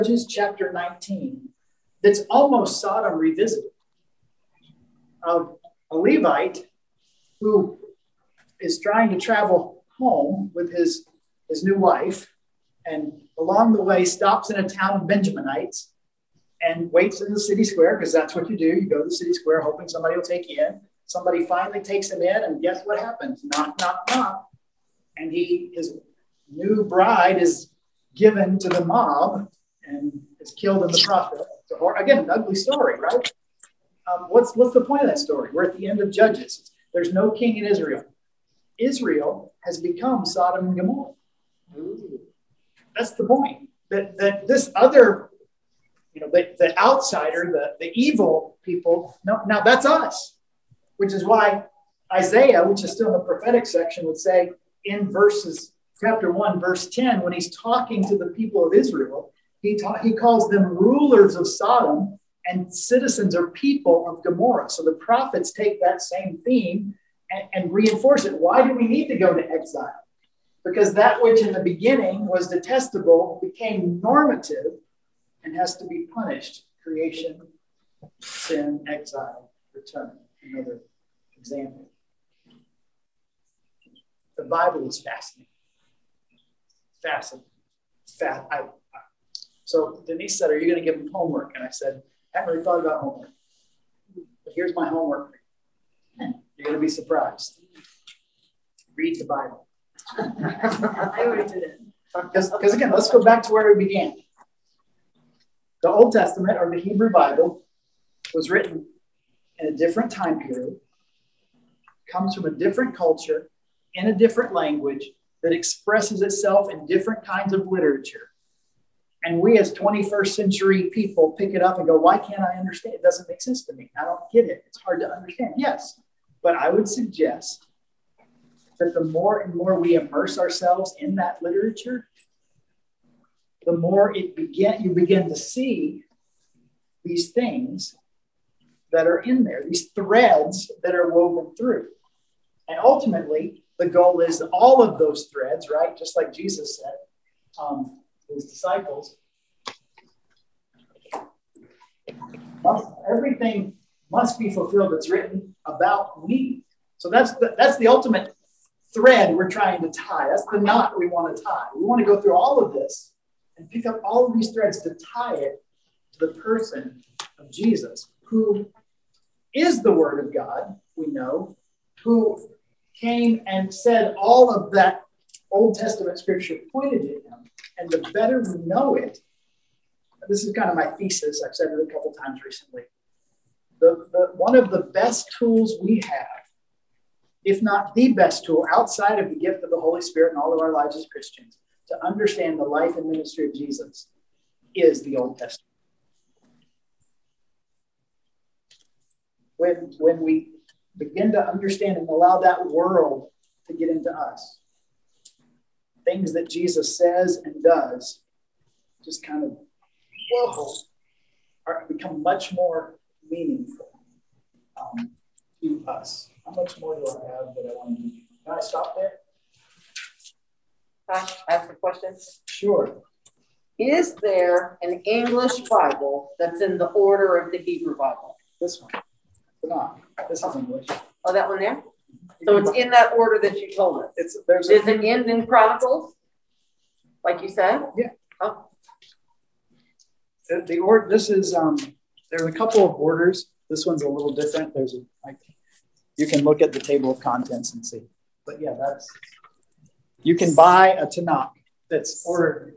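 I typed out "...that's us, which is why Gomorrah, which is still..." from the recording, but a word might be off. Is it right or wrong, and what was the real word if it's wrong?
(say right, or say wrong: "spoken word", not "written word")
wrong: "Isaiah", not "Gomorrah".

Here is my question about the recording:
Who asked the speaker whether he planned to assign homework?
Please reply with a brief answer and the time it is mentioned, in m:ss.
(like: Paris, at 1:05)
Denise, at 1:30.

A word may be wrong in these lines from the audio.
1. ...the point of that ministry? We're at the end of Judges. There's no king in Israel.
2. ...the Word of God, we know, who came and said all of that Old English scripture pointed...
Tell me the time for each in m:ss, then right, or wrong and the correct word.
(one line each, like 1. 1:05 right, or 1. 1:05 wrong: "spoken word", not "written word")
1. 0:34 wrong: "story", not "ministry"
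2. 2:49 wrong: "Testament", not "English".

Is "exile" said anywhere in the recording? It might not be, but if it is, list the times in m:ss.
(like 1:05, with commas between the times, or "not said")
1:09, 1:18.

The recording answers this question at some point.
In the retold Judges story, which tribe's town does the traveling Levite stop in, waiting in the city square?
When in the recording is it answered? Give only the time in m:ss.
0:15.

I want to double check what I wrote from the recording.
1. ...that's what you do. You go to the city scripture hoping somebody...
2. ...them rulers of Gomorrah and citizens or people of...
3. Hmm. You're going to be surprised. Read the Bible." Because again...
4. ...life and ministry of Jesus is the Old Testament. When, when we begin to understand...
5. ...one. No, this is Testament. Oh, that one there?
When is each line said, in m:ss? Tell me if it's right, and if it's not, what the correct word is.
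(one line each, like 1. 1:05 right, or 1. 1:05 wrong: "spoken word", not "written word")
1. 0:18 wrong: "square", not "scripture"
2. 1:00 wrong: "Sodom", not "Gomorrah"
3. 1:36 right
4. 3:12 right
5. 3:48 wrong: "English", not "Testament".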